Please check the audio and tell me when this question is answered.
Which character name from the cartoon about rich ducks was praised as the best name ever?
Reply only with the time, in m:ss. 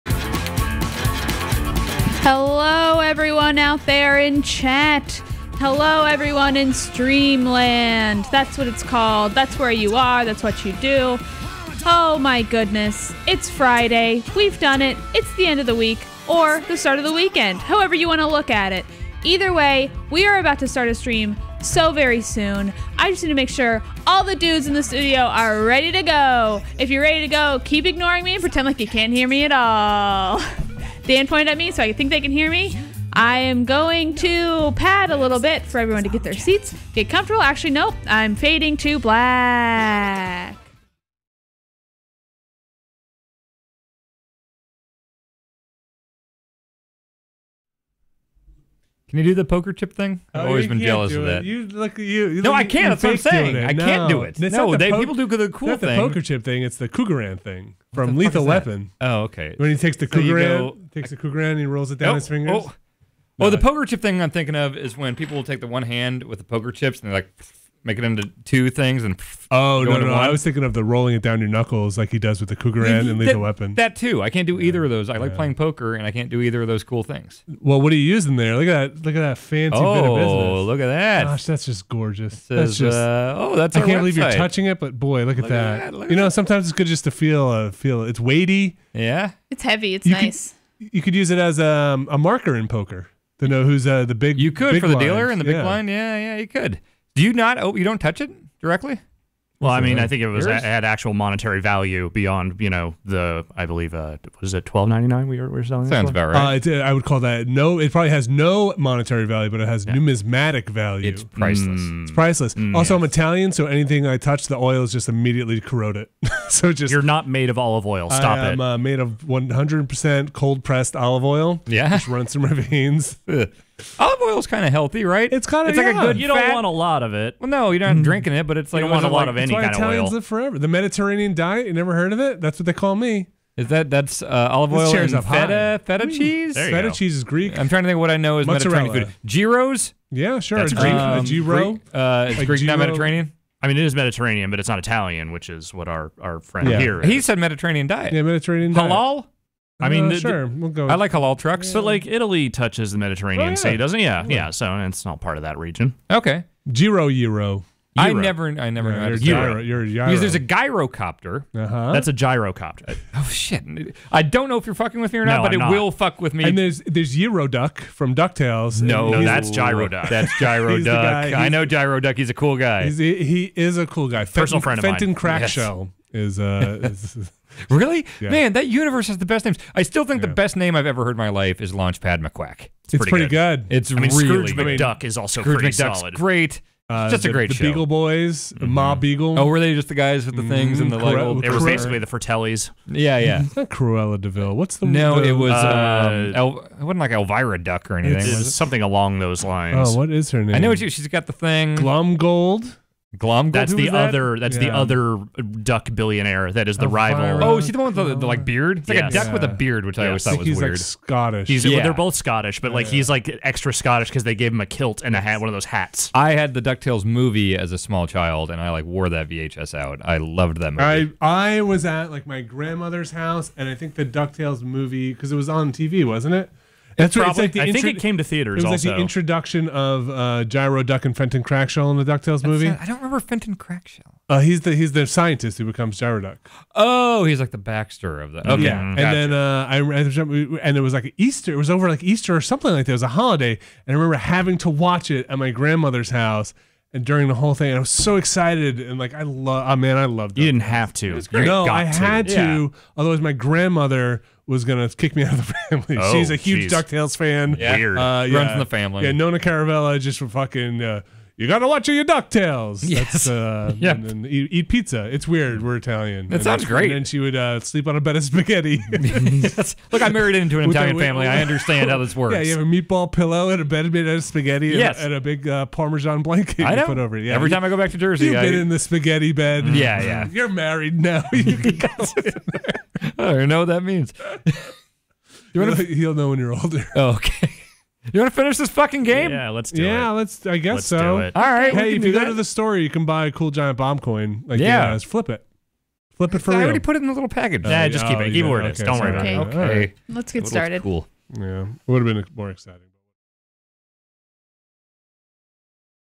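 3:01.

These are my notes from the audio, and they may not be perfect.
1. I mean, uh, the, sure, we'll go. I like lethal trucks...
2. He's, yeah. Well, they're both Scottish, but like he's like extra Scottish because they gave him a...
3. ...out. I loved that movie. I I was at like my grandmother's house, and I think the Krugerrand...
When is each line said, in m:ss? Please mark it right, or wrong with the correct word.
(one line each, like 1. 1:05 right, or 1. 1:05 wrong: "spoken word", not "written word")
1. 2:29 wrong: "halal", not "lethal"
2. 3:31 right
3. 3:39 wrong: "Ducktales", not "Krugerrand".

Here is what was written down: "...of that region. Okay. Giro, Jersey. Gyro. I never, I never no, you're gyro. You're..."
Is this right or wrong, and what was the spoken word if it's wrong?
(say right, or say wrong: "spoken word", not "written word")
wrong: "Euro", not "Jersey".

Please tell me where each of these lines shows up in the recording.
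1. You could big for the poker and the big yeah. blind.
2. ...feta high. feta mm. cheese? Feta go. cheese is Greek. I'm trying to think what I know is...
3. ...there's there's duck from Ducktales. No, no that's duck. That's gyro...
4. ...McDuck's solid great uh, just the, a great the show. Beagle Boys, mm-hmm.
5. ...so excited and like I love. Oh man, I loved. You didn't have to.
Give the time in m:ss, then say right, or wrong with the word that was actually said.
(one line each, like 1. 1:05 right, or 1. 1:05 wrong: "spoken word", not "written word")
1. 1:34 wrong: "dealer", not "poker"
2. 2:15 right
3. 2:46 right
4. 3:05 right
5. 4:07 right.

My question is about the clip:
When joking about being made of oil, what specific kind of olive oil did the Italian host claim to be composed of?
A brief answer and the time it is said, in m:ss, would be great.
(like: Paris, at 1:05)
cold pressed, at 2:00.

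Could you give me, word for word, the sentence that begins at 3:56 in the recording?
Oh, he's like the Baxter of that.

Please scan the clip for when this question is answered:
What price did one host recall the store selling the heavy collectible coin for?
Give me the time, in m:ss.
1:44.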